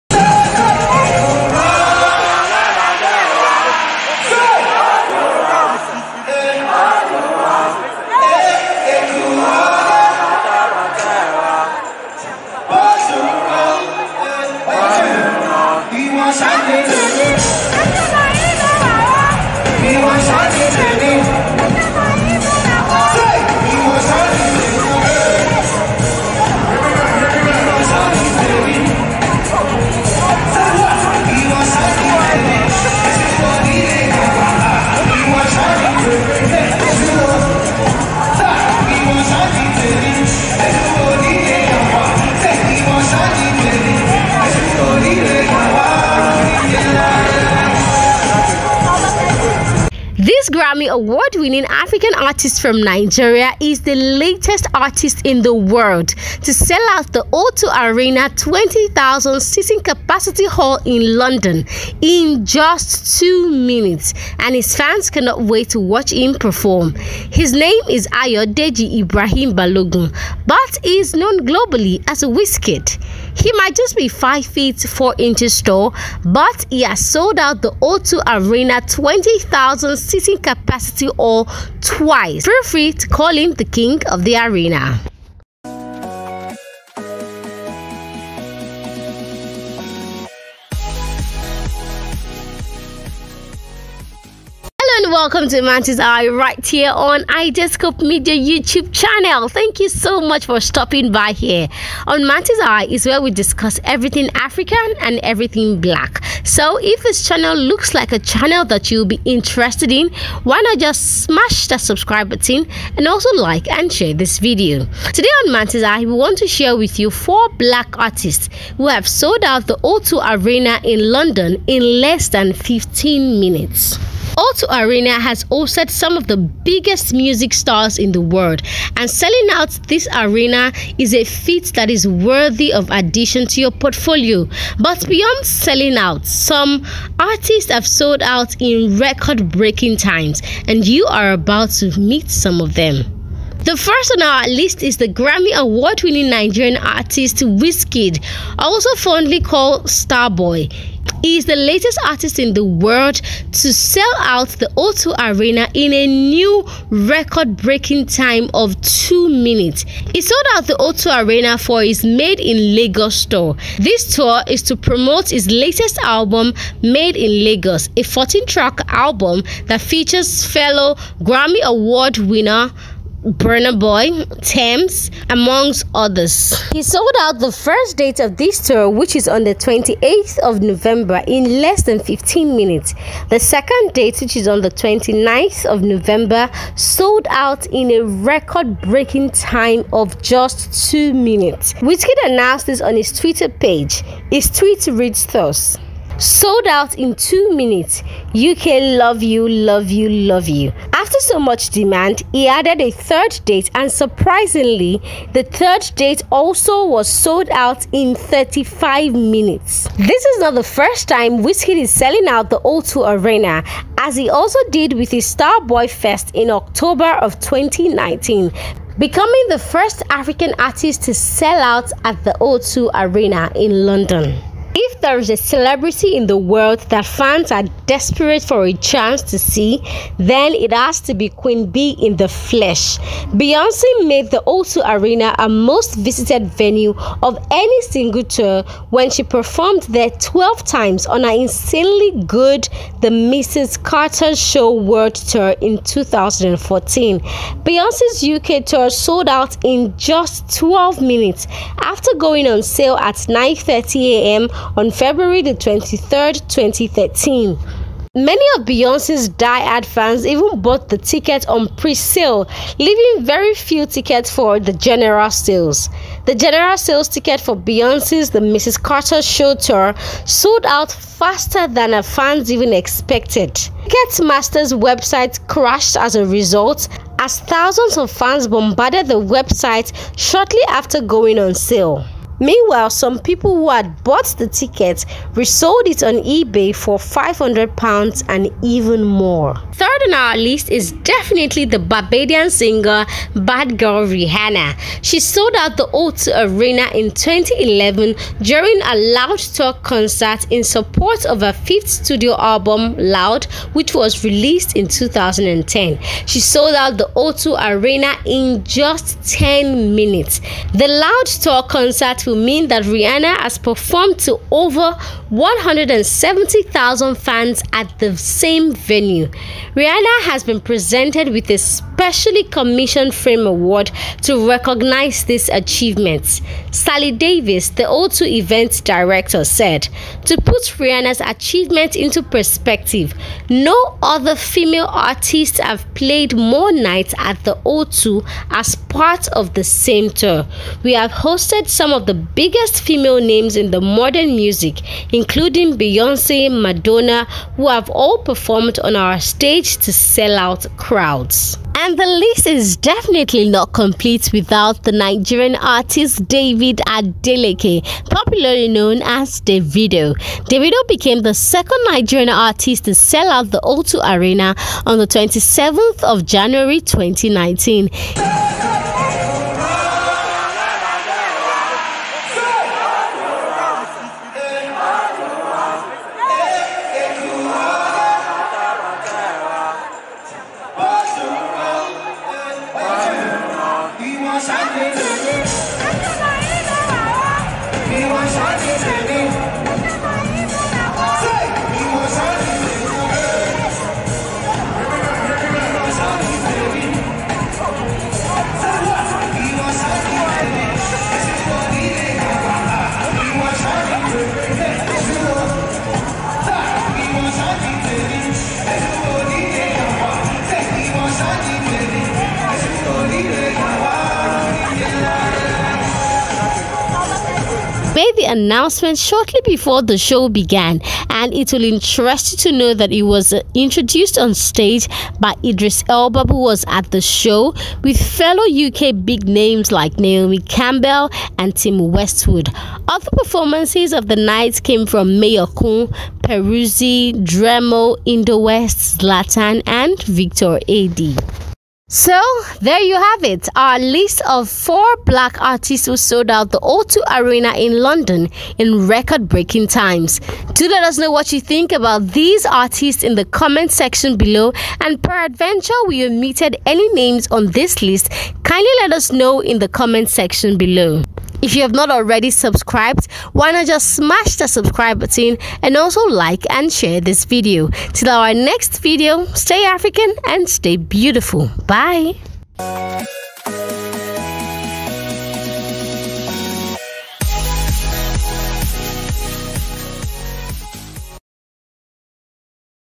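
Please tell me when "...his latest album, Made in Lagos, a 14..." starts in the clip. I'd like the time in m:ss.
2:45.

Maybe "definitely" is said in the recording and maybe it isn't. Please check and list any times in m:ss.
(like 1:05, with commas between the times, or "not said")
4:51, 5:52.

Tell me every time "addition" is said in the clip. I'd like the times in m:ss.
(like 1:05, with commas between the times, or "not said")
2:12.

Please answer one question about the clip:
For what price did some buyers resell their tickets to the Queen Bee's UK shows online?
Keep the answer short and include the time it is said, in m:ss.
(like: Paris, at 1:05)
£500, at 4:46.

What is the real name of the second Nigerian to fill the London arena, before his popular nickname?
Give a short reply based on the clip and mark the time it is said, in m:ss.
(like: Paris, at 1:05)
David Adeleke, at 5:56.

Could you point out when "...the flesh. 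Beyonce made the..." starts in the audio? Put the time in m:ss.
3:52.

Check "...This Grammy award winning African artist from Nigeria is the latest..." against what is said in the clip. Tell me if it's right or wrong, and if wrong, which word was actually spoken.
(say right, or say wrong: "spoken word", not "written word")
right.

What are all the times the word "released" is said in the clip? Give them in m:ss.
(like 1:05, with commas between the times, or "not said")
5:04.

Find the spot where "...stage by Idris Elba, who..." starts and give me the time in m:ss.
7:04.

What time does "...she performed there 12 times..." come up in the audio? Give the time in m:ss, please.
3:59.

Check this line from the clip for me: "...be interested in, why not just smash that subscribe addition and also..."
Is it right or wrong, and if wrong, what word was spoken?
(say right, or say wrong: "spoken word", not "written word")
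wrong: "button", not "addition".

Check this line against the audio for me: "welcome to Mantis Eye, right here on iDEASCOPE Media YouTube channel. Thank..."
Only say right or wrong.
right.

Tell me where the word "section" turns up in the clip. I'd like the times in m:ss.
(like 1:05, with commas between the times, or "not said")
7:33, 7:40.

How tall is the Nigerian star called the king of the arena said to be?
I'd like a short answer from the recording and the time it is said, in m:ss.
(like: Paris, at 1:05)
5 feet 4 inches, at 1:14.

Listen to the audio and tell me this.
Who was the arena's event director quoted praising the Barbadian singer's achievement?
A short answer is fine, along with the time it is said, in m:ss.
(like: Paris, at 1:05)
Sally Davis, at 5:26.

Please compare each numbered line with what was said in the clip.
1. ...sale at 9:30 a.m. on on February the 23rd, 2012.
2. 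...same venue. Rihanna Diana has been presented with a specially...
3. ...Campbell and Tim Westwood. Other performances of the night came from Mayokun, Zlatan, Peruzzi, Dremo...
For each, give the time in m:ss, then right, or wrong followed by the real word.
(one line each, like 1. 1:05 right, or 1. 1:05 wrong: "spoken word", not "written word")
1. 4:12 wrong: "2013", not "2012"
2. 5:18 right
3. 7:10 wrong: "Kun", not "Zlatan".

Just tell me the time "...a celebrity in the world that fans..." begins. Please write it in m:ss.
3:45.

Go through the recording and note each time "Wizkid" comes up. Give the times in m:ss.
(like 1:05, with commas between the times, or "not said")
1:12, 2:27, 3:11, 3:31.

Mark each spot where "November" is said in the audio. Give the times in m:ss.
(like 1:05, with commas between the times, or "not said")
3:00, 3:05.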